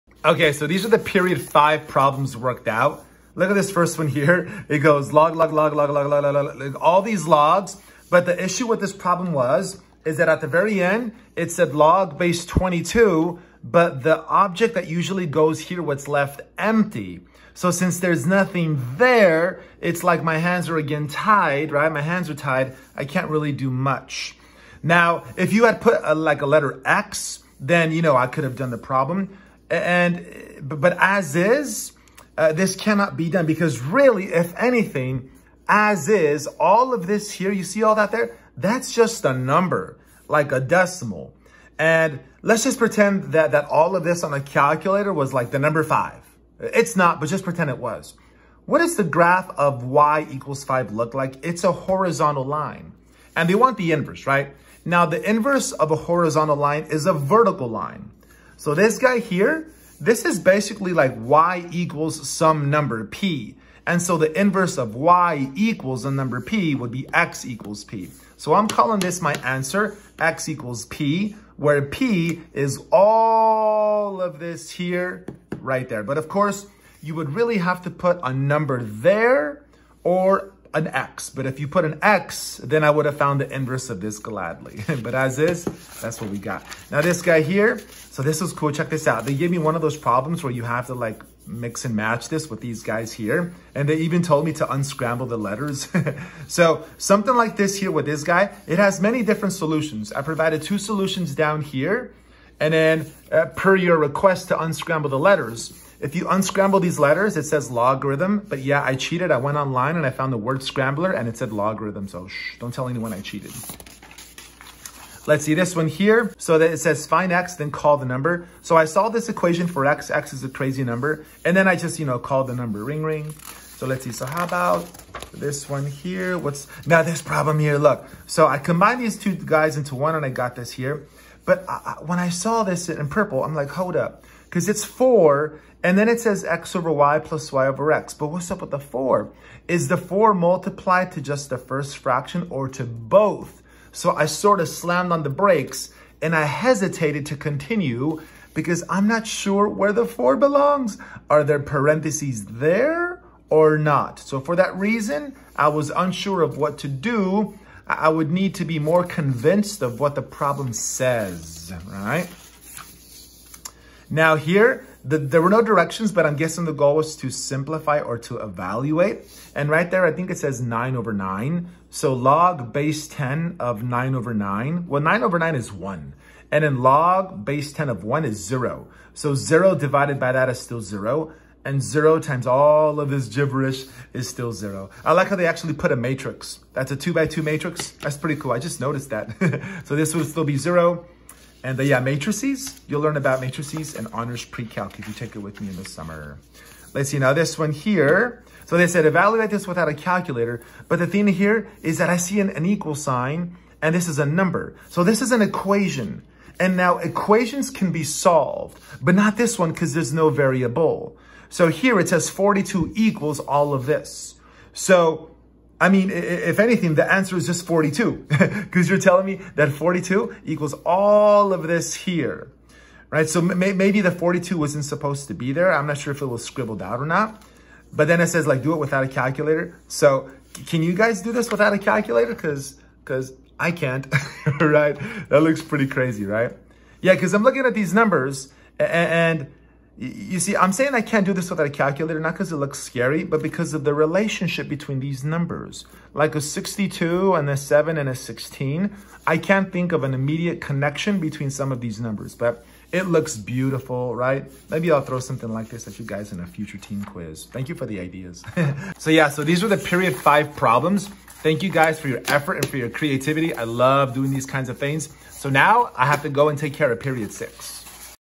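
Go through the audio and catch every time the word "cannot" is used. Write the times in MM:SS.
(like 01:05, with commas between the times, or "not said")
00:32.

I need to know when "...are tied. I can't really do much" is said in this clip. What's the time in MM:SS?
00:22.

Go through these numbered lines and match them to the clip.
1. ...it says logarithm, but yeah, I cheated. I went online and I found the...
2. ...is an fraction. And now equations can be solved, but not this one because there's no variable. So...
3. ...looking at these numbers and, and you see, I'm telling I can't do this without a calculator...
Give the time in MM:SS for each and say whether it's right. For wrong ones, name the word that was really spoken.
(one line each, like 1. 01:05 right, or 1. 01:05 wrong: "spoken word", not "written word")
1. 01:47 right
2. 03:25 wrong: "equation", not "fraction"
3. 03:57 wrong: "saying", not "telling".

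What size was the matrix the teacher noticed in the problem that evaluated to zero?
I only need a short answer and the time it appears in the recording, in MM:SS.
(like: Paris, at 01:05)
2 by 2, at 03:06.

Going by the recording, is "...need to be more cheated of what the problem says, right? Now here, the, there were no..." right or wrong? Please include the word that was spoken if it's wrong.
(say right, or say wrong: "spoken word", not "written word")
wrong: "convinced", not "cheated".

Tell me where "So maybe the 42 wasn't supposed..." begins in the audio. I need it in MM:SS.
03:43.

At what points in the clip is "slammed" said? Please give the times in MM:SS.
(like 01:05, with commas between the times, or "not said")
02:24.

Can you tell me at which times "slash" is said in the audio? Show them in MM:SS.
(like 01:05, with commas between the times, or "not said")
not said.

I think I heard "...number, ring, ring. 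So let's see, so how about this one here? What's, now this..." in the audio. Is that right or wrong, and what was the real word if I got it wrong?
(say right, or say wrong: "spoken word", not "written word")
right.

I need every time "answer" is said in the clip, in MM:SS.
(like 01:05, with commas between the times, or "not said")
01:09, 03:37.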